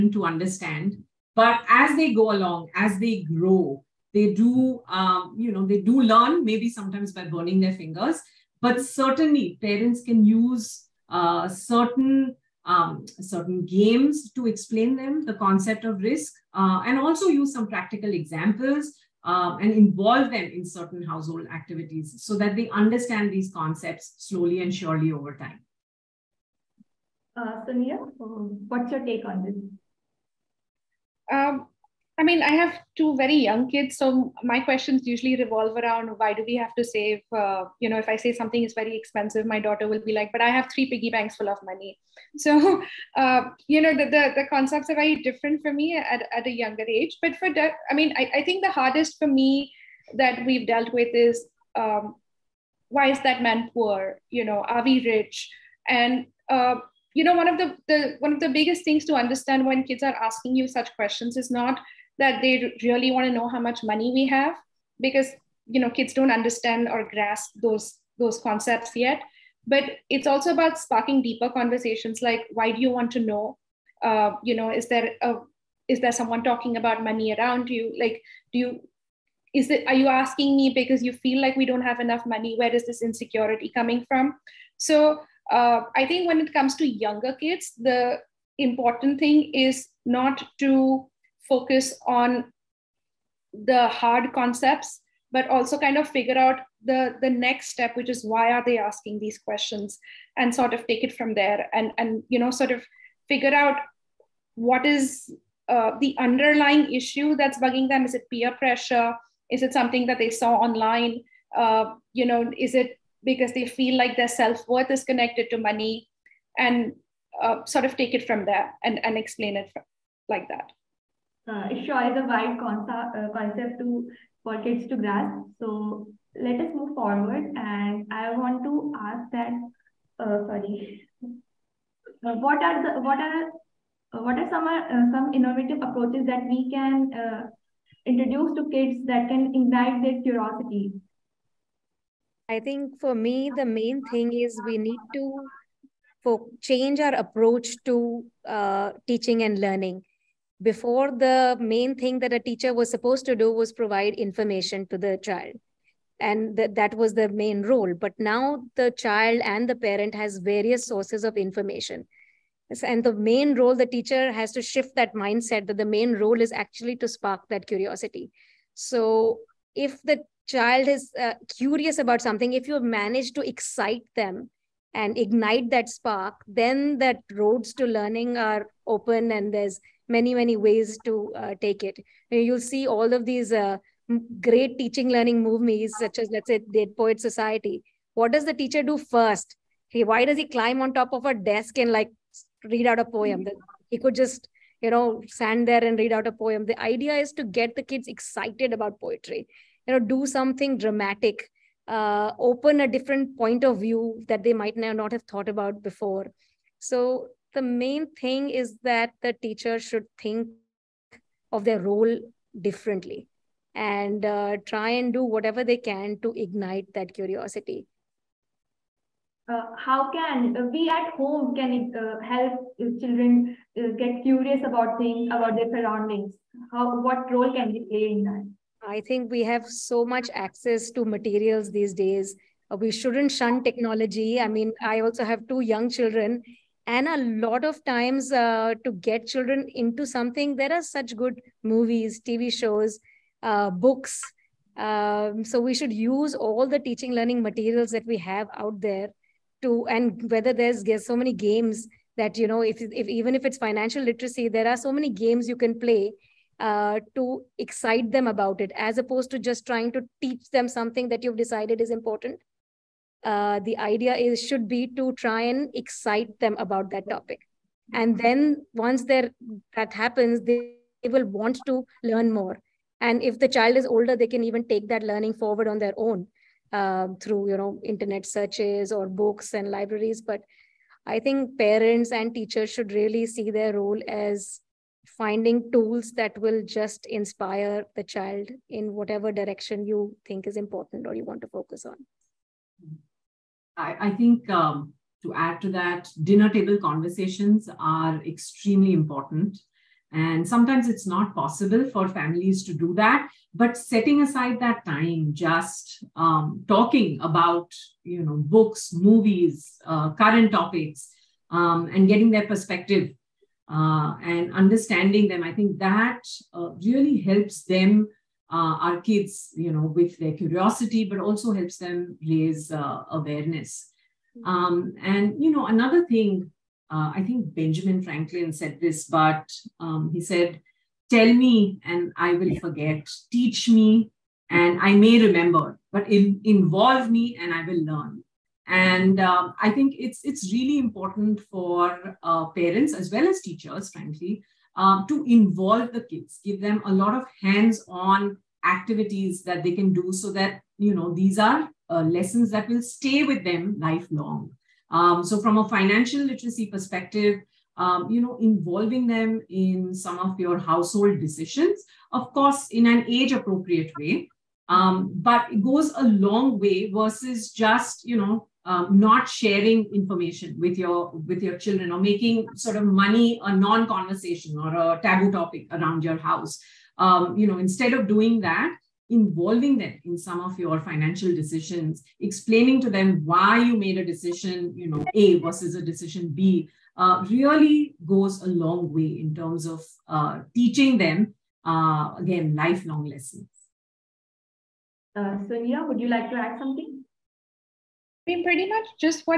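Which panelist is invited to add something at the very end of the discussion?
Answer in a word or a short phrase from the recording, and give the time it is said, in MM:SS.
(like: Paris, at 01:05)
Sonia, at 06:35.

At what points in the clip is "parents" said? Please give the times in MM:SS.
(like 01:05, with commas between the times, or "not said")
00:09, 02:39, 04:41, 05:42.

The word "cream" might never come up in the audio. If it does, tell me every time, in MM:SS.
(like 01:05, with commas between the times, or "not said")
not said.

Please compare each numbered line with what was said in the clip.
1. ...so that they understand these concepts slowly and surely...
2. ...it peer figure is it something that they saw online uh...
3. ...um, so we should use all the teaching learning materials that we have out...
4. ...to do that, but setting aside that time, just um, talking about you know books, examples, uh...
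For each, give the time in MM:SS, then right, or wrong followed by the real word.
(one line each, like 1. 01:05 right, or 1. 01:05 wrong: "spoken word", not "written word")
1. 00:22 right
2. 01:48 wrong: "pressure", not "figure"
3. 04:04 right
4. 05:02 wrong: "movies", not "examples".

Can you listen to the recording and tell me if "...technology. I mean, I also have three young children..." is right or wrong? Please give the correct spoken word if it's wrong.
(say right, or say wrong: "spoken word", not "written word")
wrong: "two", not "three".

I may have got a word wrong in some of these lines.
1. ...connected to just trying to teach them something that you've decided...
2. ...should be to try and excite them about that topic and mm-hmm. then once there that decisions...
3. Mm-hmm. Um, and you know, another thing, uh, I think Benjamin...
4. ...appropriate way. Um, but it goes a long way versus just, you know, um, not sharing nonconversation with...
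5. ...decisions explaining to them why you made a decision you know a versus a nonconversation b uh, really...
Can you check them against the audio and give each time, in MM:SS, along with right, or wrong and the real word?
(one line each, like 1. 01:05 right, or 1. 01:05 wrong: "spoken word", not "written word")
1. 04:18 wrong: "opposed", not "connected"
2. 04:24 wrong: "happens", not "decisions"
3. 05:24 right
4. 06:03 wrong: "information", not "nonconversation"
5. 06:21 wrong: "decision", not "nonconversation".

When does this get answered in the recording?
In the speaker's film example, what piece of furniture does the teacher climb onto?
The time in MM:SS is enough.
03:11.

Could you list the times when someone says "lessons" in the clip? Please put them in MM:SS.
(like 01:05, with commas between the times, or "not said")
05:52, 06:33.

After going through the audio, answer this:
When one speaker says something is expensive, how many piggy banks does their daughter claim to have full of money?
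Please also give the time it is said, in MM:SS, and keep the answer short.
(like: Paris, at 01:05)
3, at 00:40.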